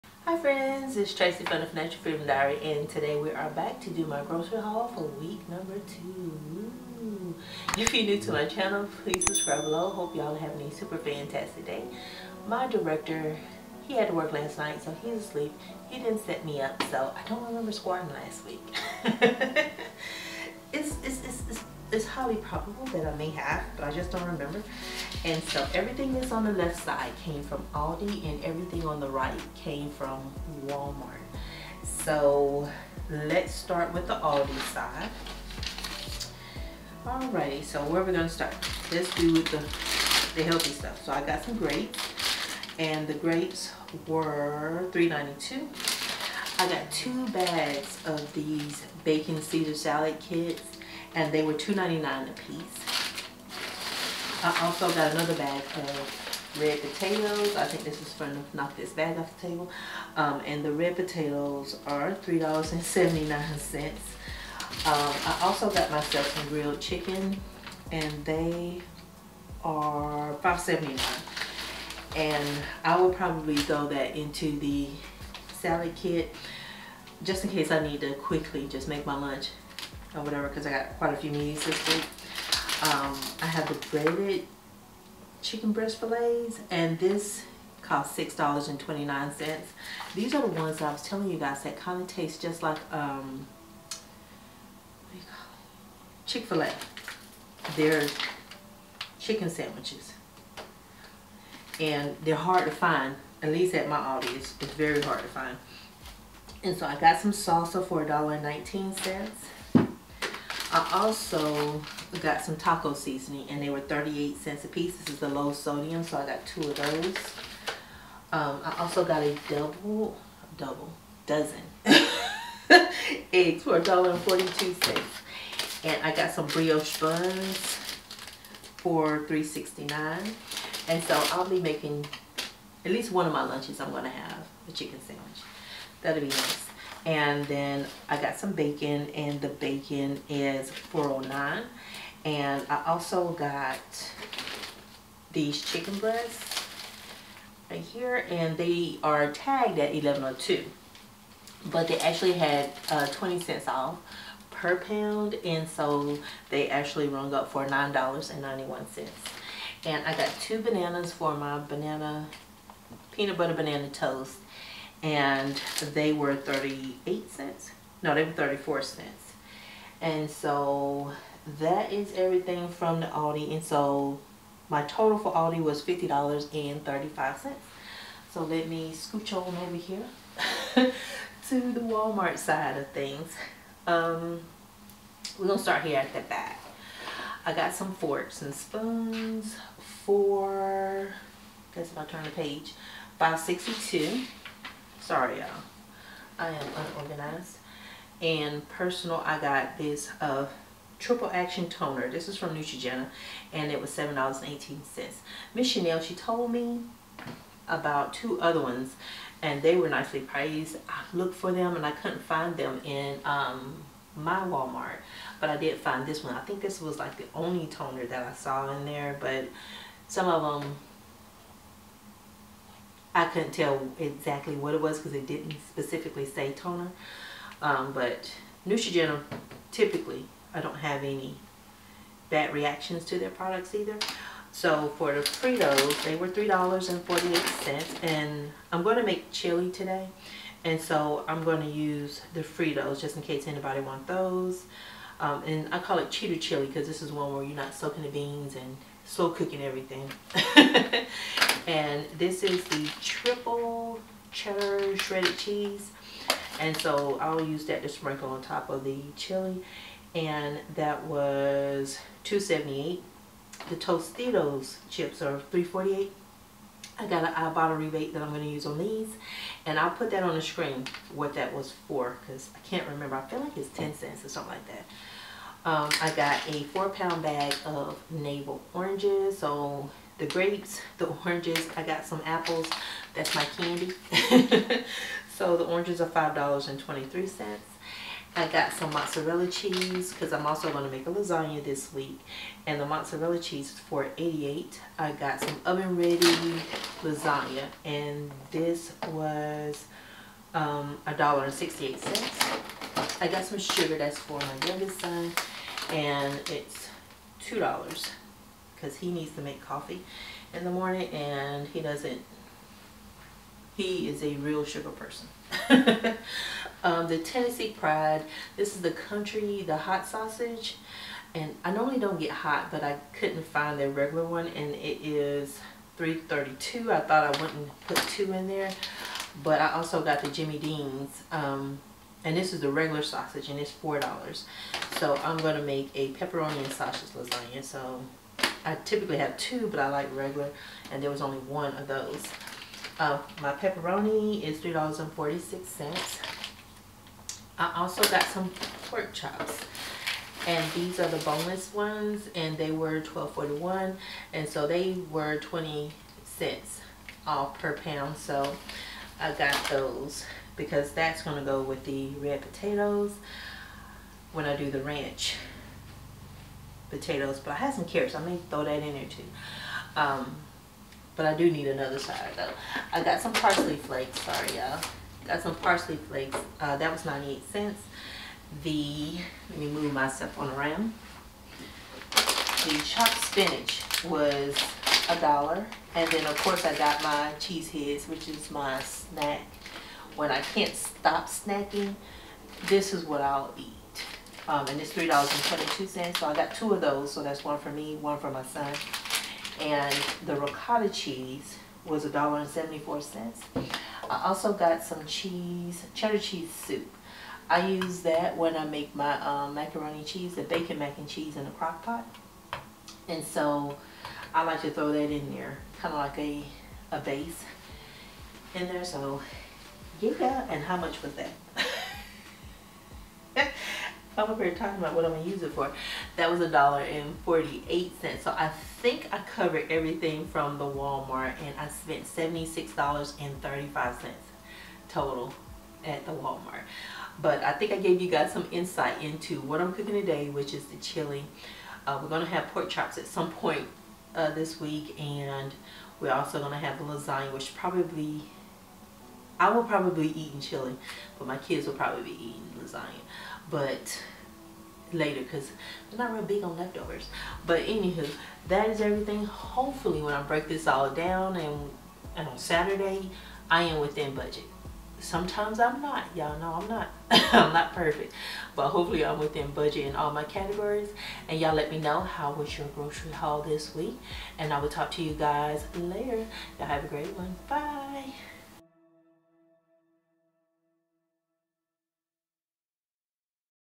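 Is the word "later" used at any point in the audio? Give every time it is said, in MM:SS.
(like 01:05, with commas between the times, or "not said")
07:34, 07:55.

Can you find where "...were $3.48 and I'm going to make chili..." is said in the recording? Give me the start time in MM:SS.
03:56.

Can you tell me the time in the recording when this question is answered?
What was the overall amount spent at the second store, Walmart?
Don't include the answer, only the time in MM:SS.
07:12.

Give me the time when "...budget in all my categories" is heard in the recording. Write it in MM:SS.
07:49.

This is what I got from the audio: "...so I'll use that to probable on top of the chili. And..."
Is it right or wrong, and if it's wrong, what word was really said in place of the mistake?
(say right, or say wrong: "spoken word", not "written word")
wrong: "sprinkle", not "probable".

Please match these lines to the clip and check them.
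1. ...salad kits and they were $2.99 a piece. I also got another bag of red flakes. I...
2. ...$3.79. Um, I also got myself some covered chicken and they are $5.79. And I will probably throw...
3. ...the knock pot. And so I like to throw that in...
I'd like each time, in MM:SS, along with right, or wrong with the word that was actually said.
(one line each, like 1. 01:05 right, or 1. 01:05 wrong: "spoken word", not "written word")
1. 00:49 wrong: "potatoes", not "flakes"
2. 01:02 wrong: "grilled", not "covered"
3. 06:51 wrong: "crock", not "knock".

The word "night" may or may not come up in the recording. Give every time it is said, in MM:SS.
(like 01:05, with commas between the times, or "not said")
00:14.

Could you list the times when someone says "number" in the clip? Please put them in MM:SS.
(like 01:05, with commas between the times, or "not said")
00:05.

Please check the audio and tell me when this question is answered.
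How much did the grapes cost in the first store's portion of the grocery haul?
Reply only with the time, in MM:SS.
00:44.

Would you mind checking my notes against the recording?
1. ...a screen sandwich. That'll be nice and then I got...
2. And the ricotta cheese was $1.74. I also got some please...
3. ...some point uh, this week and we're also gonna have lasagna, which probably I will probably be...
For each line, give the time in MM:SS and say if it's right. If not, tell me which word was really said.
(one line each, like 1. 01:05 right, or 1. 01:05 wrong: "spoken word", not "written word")
1. 02:14 wrong: "chicken", not "screen"
2. 06:39 wrong: "cheese", not "please"
3. 07:23 right.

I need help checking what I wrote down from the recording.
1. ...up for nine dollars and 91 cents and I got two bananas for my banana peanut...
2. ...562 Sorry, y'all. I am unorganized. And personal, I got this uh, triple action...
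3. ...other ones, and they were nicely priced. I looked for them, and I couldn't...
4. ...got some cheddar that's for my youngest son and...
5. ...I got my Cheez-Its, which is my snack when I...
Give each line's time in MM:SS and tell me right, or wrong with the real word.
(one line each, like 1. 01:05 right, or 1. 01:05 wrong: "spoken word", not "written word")
1. 02:37 right
2. 03:13 right
3. 03:28 right
4. 05:03 wrong: "sugar", not "cheddar"
5. 06:26 right.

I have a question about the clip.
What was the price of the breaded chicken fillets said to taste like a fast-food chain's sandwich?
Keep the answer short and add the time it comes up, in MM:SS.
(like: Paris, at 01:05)
$6.29, at 01:28.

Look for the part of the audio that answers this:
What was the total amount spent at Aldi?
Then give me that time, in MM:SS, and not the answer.
02:55.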